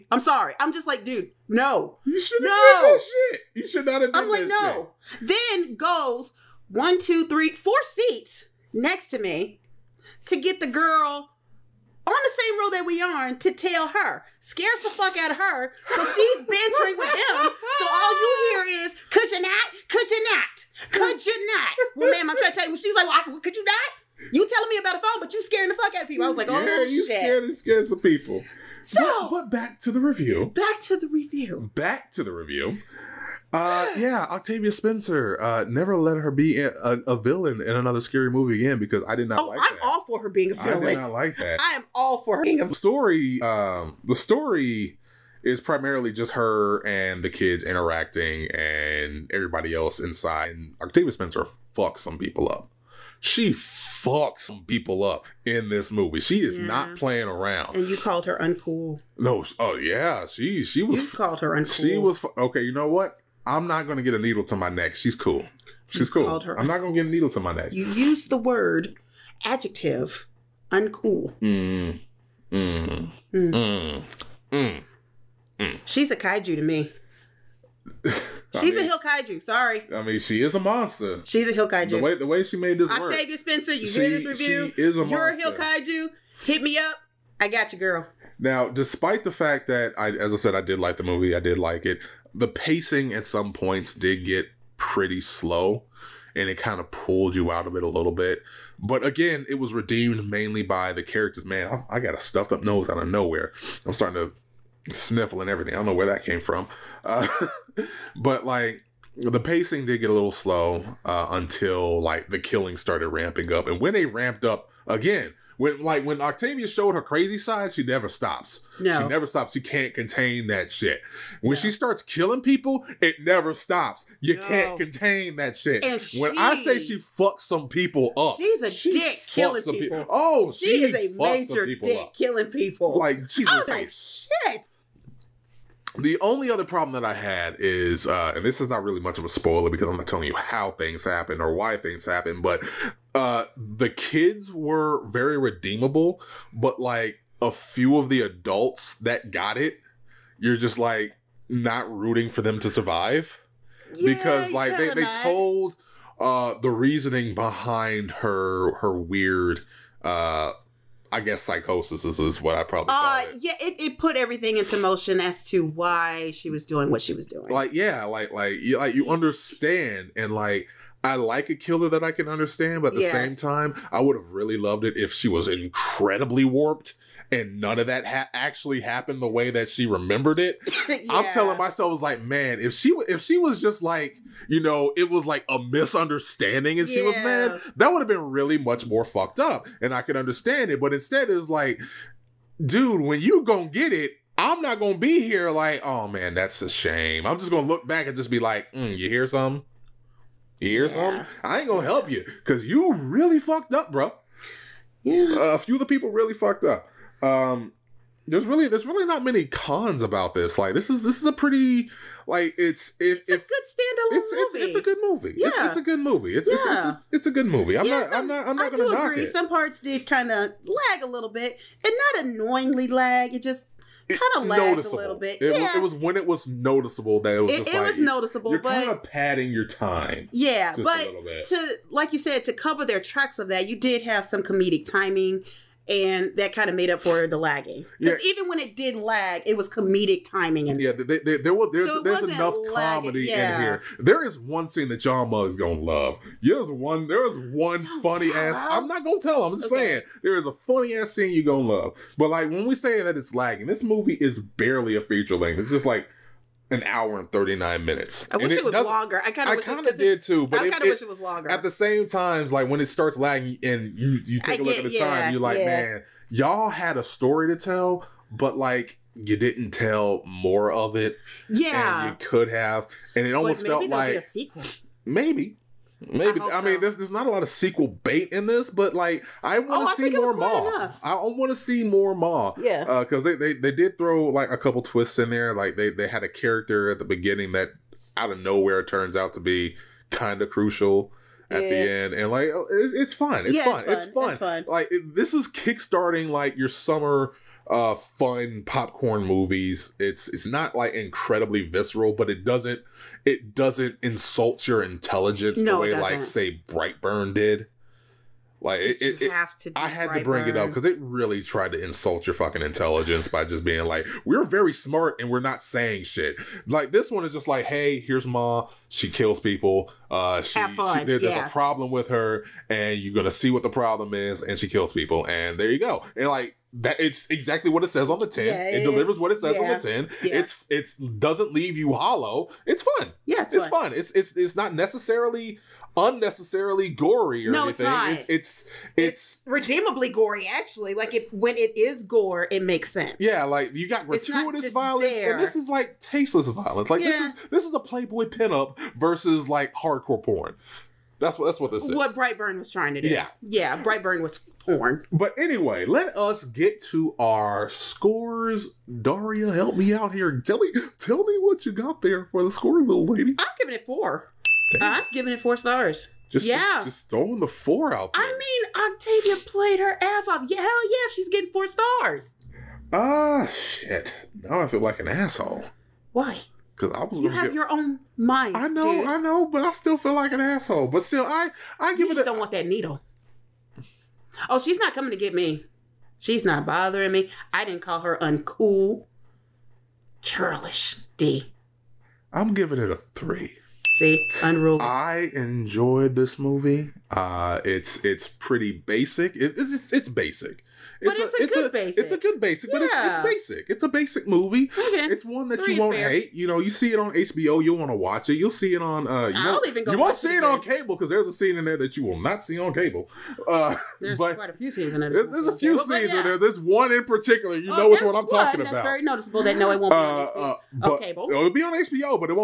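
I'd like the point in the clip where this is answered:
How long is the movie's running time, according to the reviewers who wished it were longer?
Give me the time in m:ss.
4:16.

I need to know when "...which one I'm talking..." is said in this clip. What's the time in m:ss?
6:57.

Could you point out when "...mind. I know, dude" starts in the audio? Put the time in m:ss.
6:18.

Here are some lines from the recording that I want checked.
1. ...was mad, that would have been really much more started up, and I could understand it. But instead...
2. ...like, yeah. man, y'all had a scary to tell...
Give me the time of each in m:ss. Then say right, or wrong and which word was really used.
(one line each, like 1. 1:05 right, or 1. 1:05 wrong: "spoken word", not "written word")
1. 3:07 wrong: "fucked", not "started"
2. 4:25 wrong: "story", not "scary".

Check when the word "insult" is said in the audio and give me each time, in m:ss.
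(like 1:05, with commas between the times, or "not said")
5:04, 5:11.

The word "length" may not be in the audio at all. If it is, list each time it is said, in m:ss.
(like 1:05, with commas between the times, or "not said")
4:15.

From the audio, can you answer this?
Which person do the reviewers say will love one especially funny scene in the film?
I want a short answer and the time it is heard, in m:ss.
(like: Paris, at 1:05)
John Muggs, at 4:04.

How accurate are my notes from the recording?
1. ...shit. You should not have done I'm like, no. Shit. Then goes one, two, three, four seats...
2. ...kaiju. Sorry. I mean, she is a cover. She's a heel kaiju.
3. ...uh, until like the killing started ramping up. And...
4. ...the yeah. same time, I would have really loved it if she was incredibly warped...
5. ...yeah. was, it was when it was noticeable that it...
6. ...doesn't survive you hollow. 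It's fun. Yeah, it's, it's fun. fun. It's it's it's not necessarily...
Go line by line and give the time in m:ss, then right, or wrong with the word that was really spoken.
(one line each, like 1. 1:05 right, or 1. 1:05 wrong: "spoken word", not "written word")
1. 0:03 right
2. 1:19 wrong: "monster", not "cover"
3. 1:51 right
4. 2:52 right
5. 3:45 right
6. 5:30 wrong: "leave", not "survive".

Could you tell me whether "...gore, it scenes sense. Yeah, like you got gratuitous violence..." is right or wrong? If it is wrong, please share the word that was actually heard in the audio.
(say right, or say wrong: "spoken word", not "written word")
wrong: "makes", not "scenes".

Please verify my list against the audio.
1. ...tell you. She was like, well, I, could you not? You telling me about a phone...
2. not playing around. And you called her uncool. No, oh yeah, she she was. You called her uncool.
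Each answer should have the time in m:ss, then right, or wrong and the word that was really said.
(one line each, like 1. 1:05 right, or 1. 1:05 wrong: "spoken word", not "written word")
1. 0:22 right
2. 0:56 right.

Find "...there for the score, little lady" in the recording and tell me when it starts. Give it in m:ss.
6:02.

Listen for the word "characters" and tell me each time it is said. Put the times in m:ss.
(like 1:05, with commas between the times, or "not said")
1:41, 4:46.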